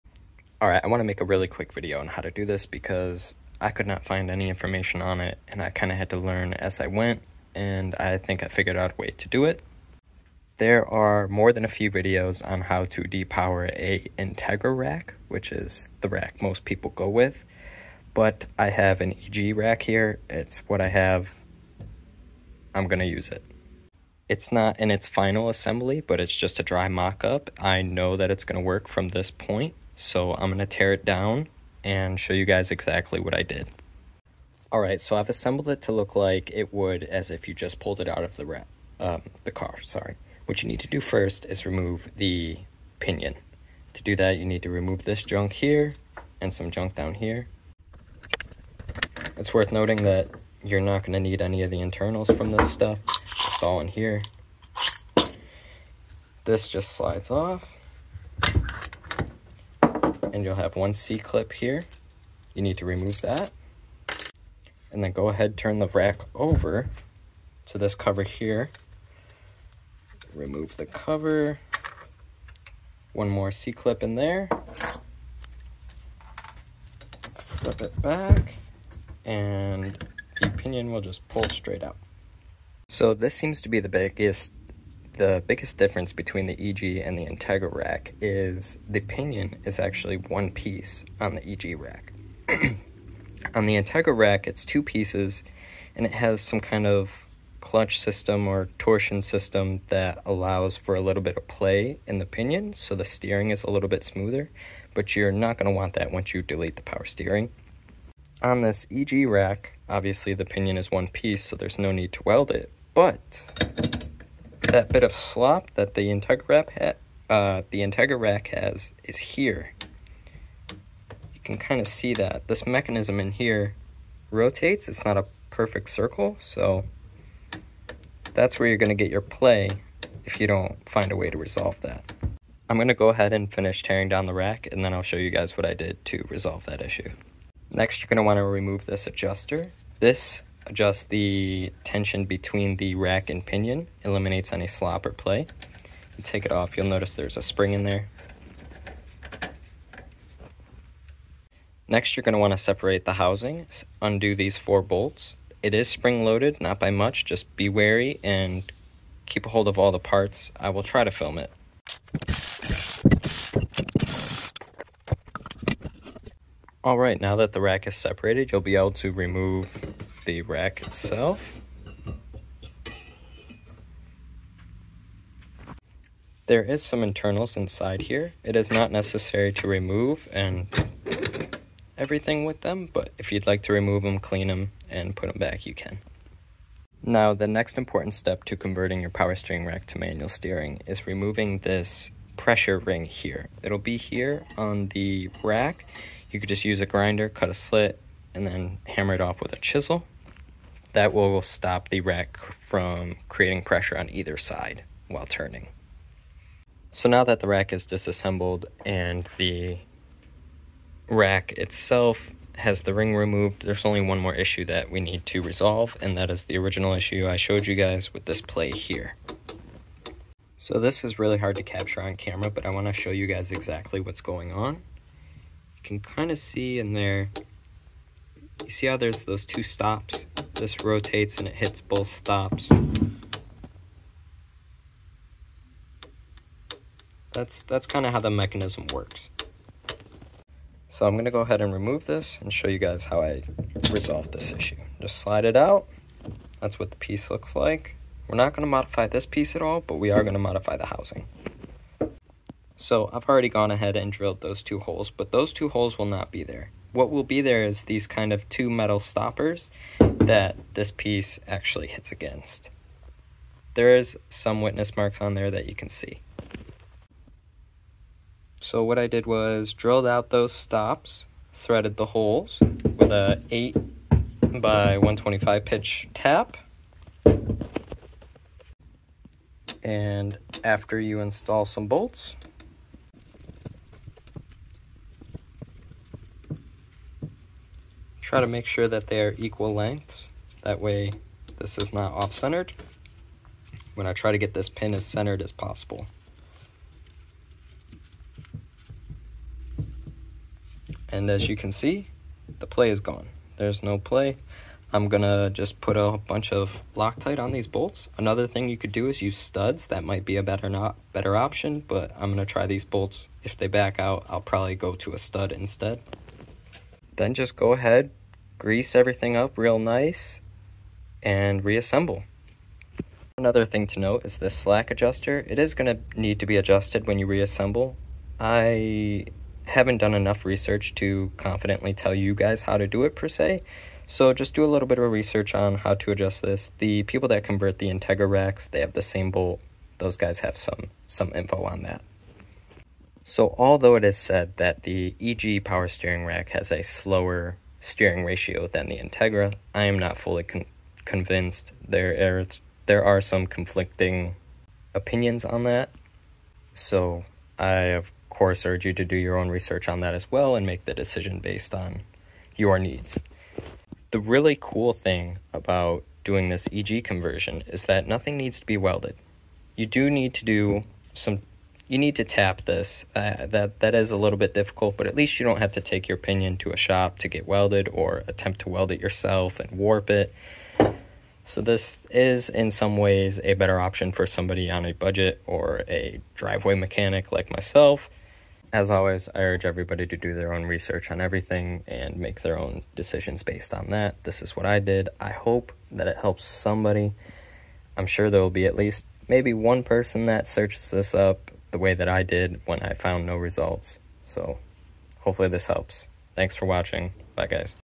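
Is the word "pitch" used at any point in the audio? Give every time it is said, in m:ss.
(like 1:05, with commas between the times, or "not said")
4:35.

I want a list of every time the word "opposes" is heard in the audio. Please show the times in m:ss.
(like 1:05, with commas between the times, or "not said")
not said.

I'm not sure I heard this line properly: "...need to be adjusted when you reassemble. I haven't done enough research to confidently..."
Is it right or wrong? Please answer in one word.
right.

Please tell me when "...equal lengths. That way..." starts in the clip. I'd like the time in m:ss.
4:49.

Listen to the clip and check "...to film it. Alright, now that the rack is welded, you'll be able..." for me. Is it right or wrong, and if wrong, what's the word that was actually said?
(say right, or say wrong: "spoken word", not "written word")
wrong: "separated", not "welded".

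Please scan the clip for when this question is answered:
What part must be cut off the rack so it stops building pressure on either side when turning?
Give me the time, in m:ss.
3:12.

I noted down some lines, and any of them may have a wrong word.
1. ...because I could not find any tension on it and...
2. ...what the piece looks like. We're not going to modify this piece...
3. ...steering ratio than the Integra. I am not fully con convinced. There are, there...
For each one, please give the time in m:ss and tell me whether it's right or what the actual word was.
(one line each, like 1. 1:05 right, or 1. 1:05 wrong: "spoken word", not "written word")
1. 0:02 wrong: "information", not "tension"
2. 4:06 right
3. 5:47 right.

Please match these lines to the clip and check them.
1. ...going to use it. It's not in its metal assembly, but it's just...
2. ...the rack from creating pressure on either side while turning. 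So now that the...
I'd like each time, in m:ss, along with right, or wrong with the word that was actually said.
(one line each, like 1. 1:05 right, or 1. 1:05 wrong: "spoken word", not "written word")
1. 0:22 wrong: "final", not "metal"
2. 3:21 right.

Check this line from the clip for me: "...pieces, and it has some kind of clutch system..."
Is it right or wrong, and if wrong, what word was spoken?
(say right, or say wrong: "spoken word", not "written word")
right.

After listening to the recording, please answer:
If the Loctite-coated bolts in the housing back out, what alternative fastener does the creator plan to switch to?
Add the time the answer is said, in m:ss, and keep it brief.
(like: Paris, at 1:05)
studs, at 5:15.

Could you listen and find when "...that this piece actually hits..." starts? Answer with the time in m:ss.
4:19.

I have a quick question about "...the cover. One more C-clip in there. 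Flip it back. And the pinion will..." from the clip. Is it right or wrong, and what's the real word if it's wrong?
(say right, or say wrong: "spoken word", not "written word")
right.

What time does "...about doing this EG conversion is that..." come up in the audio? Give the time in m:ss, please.
6:05.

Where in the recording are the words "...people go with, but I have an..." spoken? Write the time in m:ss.
0:16.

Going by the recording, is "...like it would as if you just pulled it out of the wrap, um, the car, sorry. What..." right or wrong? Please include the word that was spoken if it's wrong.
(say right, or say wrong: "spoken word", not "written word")
right.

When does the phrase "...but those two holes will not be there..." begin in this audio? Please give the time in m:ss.
4:15.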